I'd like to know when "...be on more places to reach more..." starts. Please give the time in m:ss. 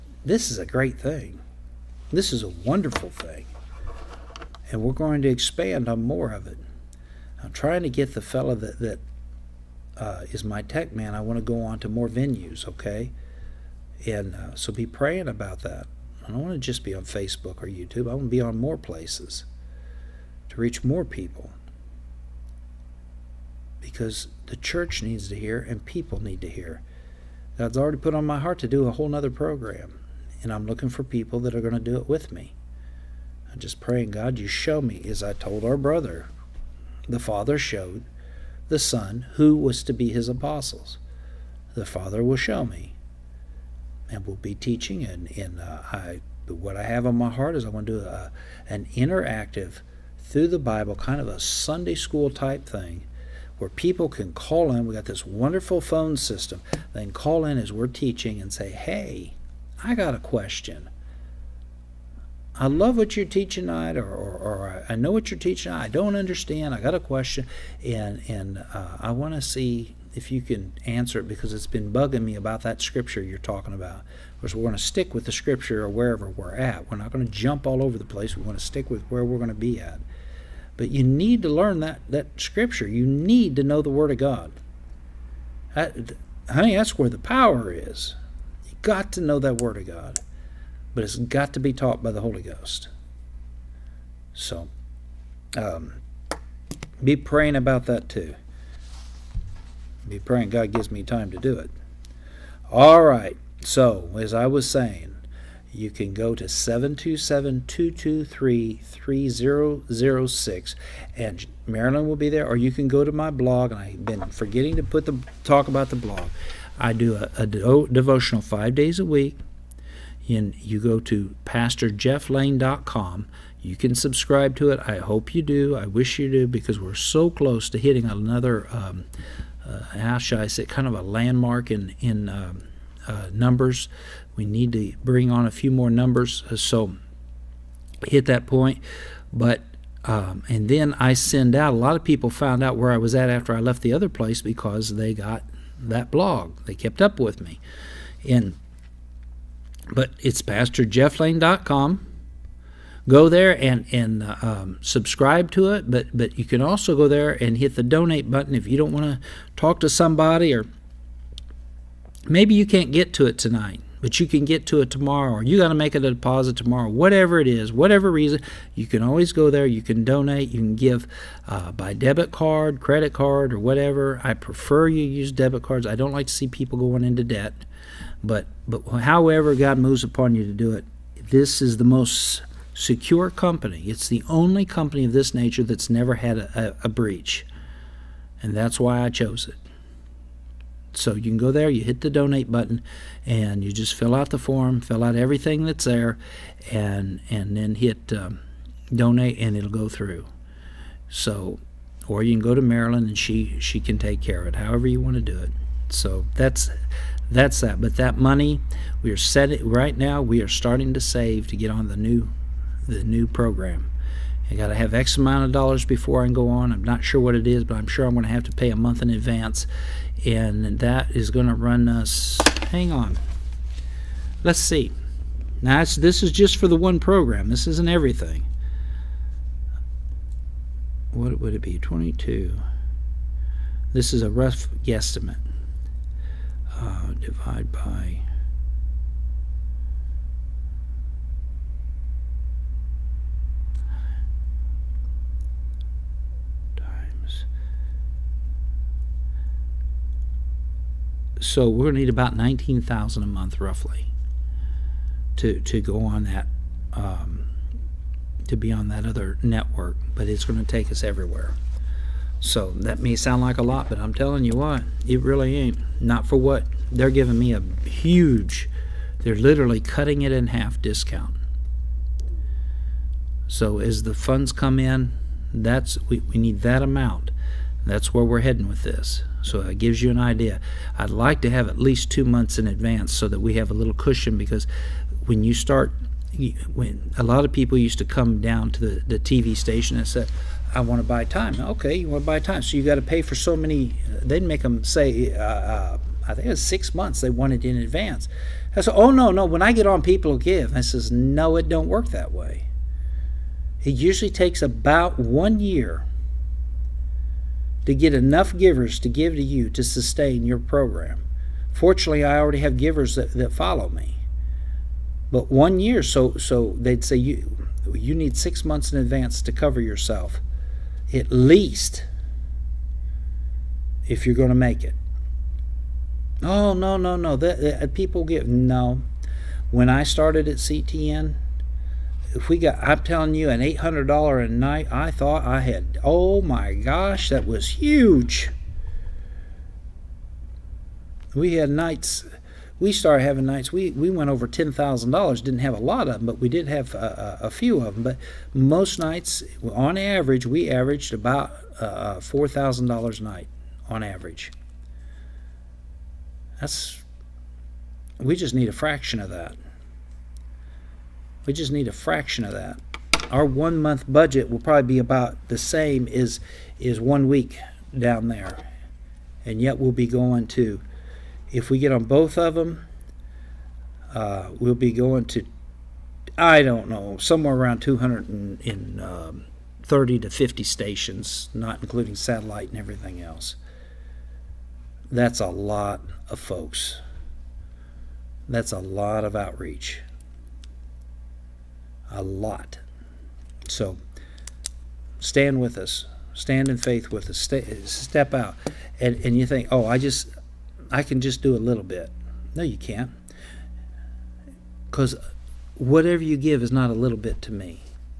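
0:18.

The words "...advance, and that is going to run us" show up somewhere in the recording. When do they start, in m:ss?
3:39.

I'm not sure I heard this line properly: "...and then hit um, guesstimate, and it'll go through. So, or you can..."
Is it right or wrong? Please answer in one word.
wrong.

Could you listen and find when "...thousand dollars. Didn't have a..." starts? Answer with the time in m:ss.
5:44.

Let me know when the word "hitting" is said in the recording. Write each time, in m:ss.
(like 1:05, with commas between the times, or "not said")
2:07.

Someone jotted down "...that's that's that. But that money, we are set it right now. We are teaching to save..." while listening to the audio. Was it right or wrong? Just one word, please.
wrong.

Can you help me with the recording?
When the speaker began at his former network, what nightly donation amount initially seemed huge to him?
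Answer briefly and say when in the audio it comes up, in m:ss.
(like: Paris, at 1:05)
$800, at 5:33.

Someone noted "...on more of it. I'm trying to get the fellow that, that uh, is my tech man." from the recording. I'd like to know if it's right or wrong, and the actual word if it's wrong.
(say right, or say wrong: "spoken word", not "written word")
right.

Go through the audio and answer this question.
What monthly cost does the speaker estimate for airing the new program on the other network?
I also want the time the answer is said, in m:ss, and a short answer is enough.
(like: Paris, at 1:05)
19,000, at 4:12.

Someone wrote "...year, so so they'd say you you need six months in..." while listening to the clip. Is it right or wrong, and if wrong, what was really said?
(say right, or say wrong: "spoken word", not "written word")
right.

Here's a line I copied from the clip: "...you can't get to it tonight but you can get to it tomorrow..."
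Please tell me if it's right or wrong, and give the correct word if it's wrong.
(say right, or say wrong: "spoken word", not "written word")
right.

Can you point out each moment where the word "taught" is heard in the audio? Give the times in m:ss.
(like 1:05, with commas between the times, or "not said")
1:31.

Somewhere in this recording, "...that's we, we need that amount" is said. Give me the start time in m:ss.
4:35.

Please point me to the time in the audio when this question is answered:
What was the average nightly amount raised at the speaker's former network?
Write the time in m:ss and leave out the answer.
5:52.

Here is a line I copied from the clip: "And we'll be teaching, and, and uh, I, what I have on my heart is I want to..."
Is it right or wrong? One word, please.
right.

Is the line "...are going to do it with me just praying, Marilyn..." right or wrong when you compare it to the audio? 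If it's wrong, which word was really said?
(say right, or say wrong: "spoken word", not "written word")
wrong: "God", not "Marilyn".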